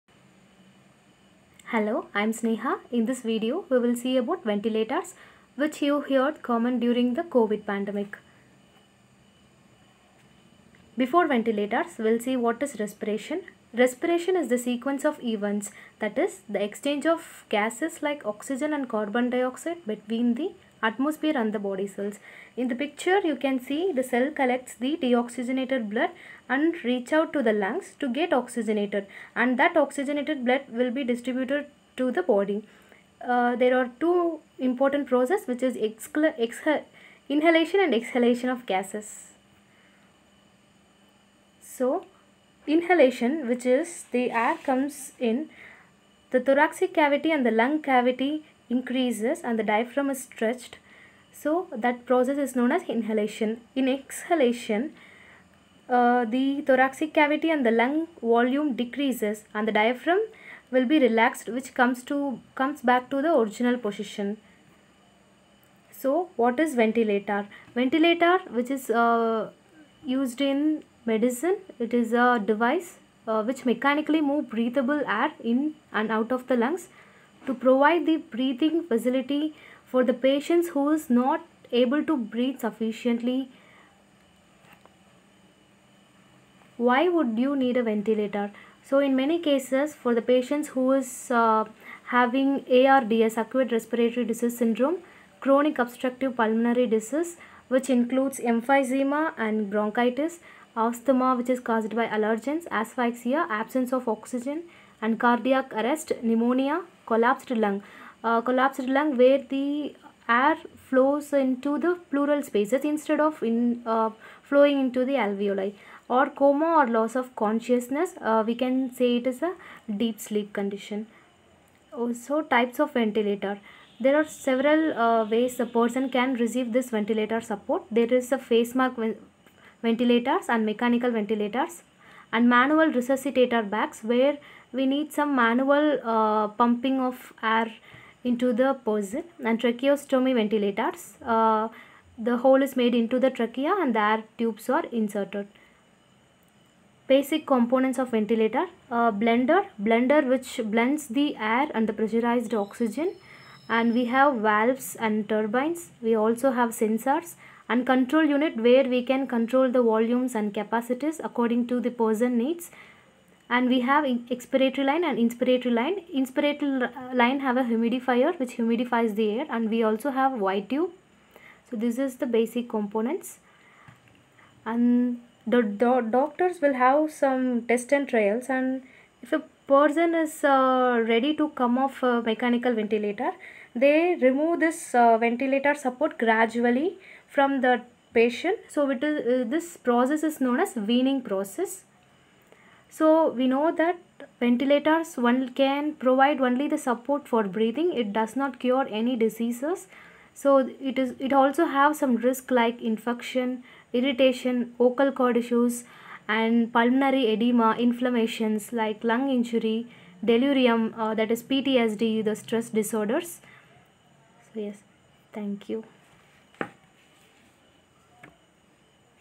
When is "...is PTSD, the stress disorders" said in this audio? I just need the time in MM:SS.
03:31.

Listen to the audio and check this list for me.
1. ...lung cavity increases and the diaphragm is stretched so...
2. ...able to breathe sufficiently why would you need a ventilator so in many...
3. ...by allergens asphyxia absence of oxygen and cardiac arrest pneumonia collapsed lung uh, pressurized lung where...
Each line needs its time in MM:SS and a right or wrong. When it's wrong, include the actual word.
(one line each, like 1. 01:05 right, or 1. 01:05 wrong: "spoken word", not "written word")
1. 00:47 right
2. 01:21 right
3. 01:42 wrong: "collapsed", not "pressurized".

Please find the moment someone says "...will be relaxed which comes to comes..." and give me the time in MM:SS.
01:00.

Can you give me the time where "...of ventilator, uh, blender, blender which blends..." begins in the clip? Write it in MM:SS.
02:27.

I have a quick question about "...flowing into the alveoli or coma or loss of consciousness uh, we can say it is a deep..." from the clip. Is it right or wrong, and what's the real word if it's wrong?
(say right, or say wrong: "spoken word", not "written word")
right.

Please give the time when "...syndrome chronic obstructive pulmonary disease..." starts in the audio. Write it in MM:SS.
01:34.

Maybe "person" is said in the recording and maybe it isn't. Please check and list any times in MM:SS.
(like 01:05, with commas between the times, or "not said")
02:05, 02:18, 02:41, 02:59.